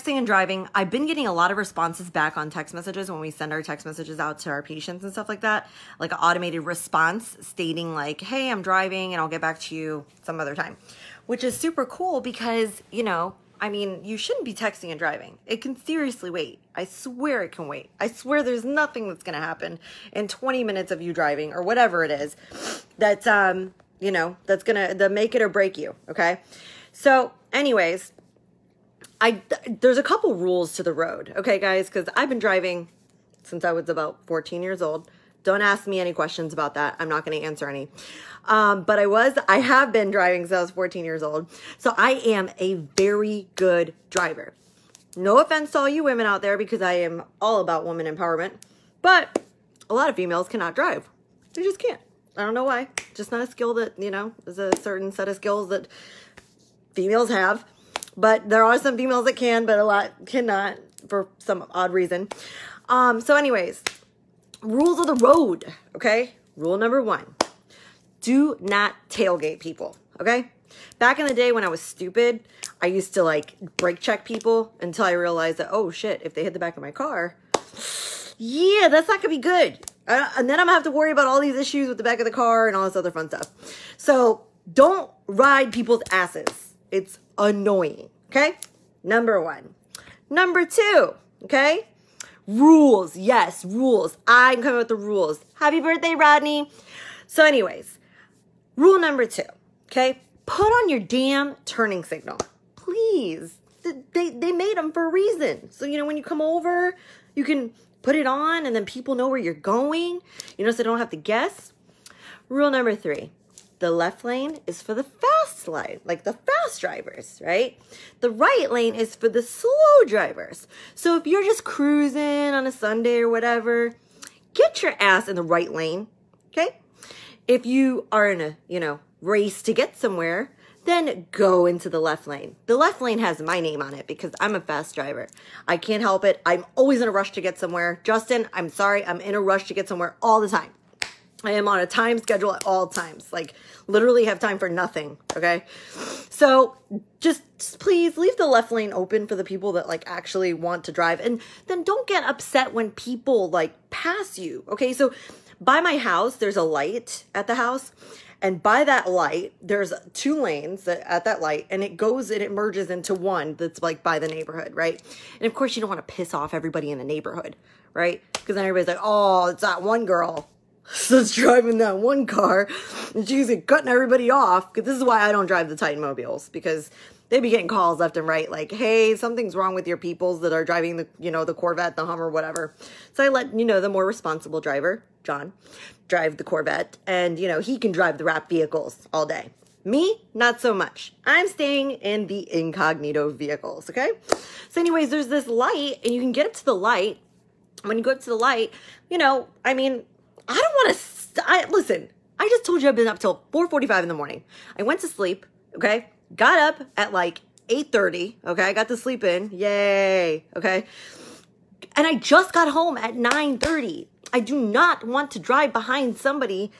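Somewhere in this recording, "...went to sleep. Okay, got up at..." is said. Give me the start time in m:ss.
3:24.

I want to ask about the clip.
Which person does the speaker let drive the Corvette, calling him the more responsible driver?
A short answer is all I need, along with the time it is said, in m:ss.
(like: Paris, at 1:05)
John, at 3:05.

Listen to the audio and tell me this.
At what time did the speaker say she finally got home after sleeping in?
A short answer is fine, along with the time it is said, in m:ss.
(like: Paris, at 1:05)
9:30, at 3:33.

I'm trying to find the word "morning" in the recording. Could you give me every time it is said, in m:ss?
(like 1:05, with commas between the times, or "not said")
3:24.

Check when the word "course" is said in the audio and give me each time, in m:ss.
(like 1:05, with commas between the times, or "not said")
2:45.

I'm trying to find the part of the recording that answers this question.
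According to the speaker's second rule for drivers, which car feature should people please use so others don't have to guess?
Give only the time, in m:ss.
1:41.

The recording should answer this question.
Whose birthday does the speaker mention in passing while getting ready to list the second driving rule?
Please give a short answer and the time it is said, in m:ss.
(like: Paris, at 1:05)
Rodney, at 1:36.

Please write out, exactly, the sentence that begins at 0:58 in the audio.
But there are some females that can, but a lot cannot for some odd reason.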